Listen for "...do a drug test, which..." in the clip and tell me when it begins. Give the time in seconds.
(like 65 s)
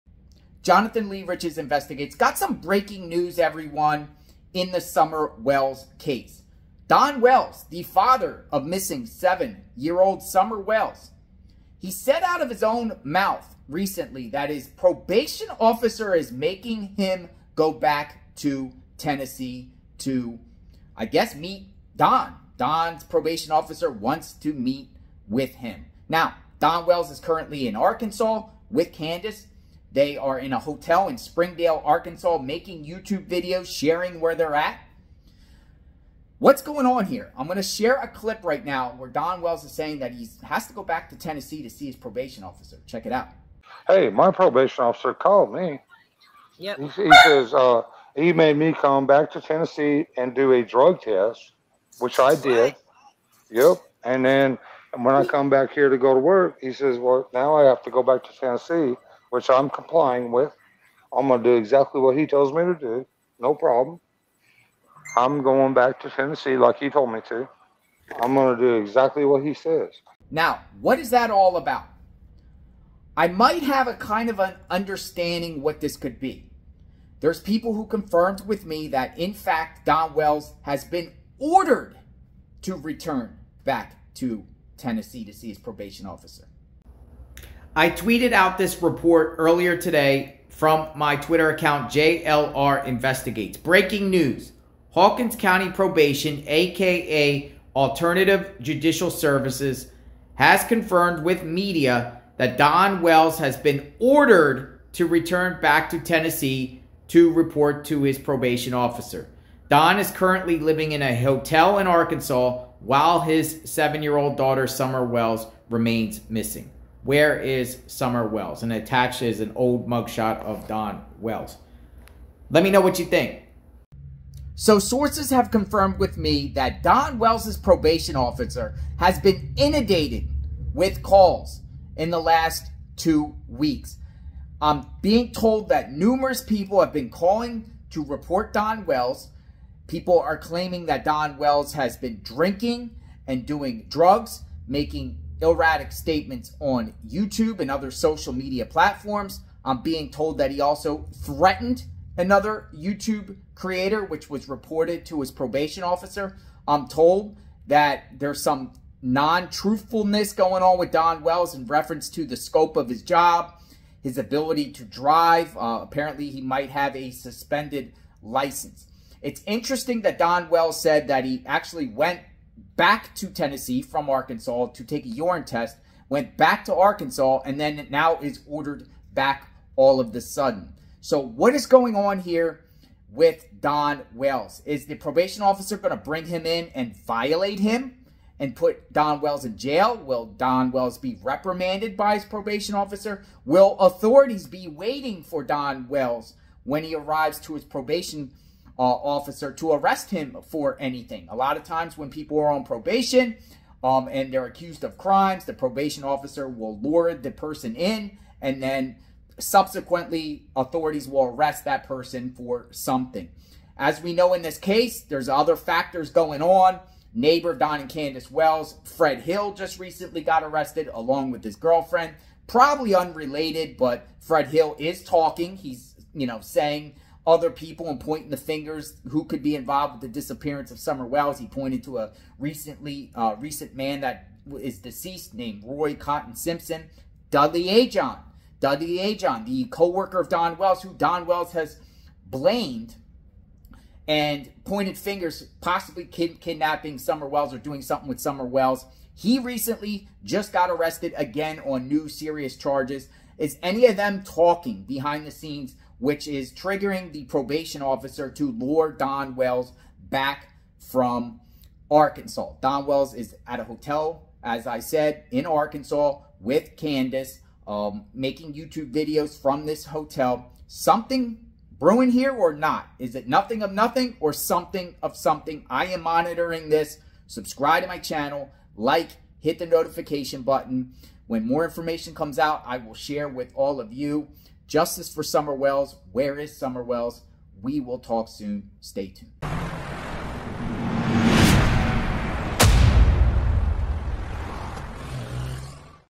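50 s.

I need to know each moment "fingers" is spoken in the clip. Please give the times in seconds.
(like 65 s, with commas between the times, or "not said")
228 s, 244 s.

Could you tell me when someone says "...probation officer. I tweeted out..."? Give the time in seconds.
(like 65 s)
85 s.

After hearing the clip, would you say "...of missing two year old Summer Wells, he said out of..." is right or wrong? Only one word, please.
wrong.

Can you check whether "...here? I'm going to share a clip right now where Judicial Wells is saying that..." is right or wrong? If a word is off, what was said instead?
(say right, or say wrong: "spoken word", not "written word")
wrong: "Don", not "Judicial".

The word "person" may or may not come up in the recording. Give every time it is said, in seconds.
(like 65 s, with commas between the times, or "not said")
207 s, 211 s.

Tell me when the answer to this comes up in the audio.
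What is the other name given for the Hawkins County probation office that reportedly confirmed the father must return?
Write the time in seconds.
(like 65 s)
97 s.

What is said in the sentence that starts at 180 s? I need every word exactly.
So what is going on here with Don Wells?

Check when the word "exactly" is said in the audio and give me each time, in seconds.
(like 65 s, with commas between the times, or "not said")
61 s, 68 s.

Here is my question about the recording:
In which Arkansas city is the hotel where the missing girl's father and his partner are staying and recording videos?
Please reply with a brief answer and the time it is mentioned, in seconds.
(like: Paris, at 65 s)
Springdale, at 31 s.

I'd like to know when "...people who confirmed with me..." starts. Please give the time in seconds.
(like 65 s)
77 s.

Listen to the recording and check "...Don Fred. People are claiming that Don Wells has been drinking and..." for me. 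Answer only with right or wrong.
wrong.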